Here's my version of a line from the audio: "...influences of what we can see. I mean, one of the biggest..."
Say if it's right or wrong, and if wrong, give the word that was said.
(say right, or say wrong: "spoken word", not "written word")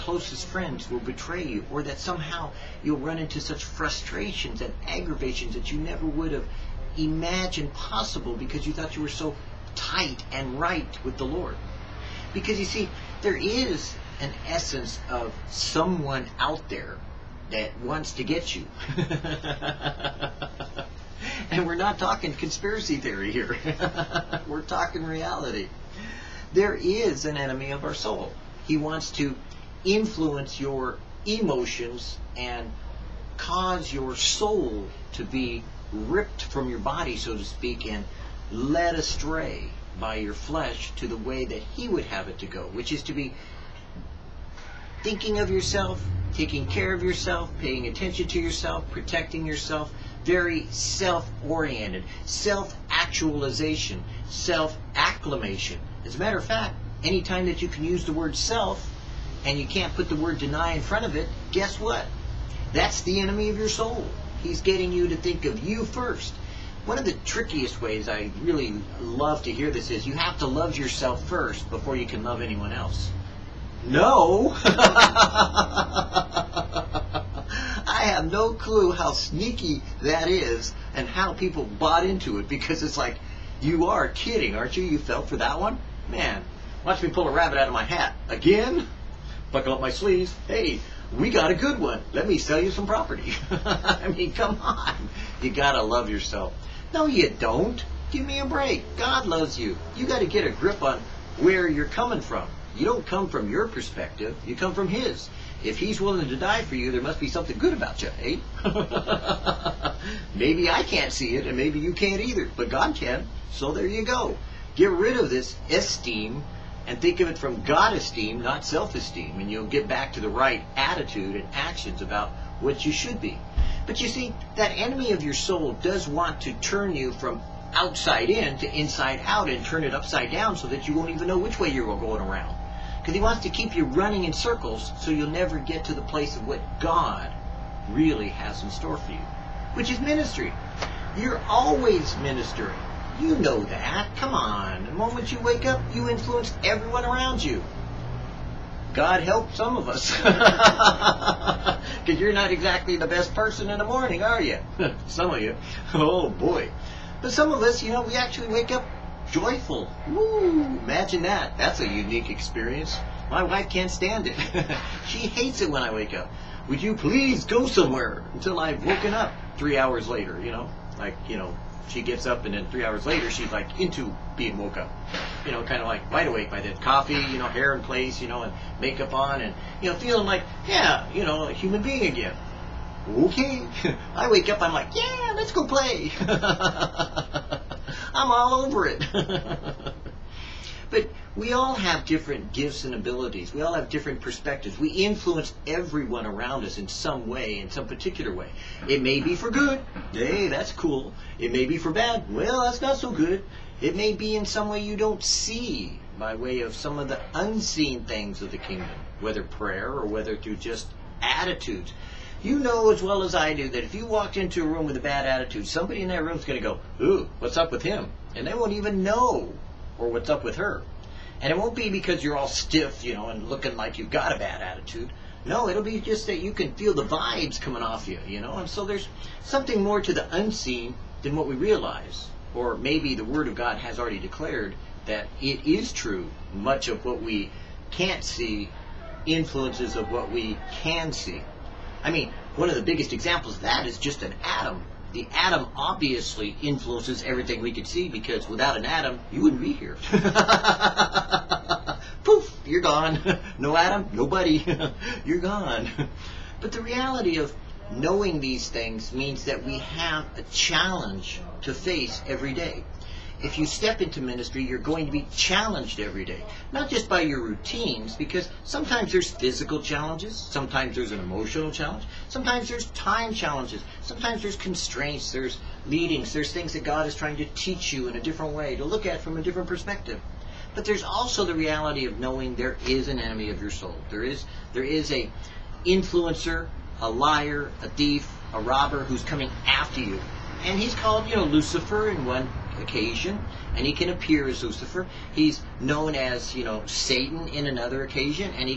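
right.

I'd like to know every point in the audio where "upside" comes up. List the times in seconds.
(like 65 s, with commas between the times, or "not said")
129 s.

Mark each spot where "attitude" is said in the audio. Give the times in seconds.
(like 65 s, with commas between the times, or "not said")
120 s, 211 s, 215 s, 224 s.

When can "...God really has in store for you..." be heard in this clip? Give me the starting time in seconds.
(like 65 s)
136 s.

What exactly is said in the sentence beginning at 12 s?
Because you see, there is an essence of someone out there that wants to get you.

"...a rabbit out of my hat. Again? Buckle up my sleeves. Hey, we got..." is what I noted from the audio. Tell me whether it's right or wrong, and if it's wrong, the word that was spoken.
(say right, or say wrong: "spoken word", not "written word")
right.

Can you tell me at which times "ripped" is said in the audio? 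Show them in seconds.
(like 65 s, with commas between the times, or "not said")
35 s.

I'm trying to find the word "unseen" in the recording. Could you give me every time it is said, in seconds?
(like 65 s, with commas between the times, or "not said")
207 s, 230 s.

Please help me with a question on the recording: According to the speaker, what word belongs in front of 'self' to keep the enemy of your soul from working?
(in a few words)
deny.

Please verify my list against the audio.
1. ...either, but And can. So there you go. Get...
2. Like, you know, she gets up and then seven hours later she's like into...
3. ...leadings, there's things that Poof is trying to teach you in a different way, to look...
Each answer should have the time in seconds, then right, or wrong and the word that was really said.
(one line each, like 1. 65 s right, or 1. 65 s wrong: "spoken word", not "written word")
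1. 112 s wrong: "God", not "And"
2. 170 s wrong: "three", not "seven"
3. 275 s wrong: "God", not "Poof".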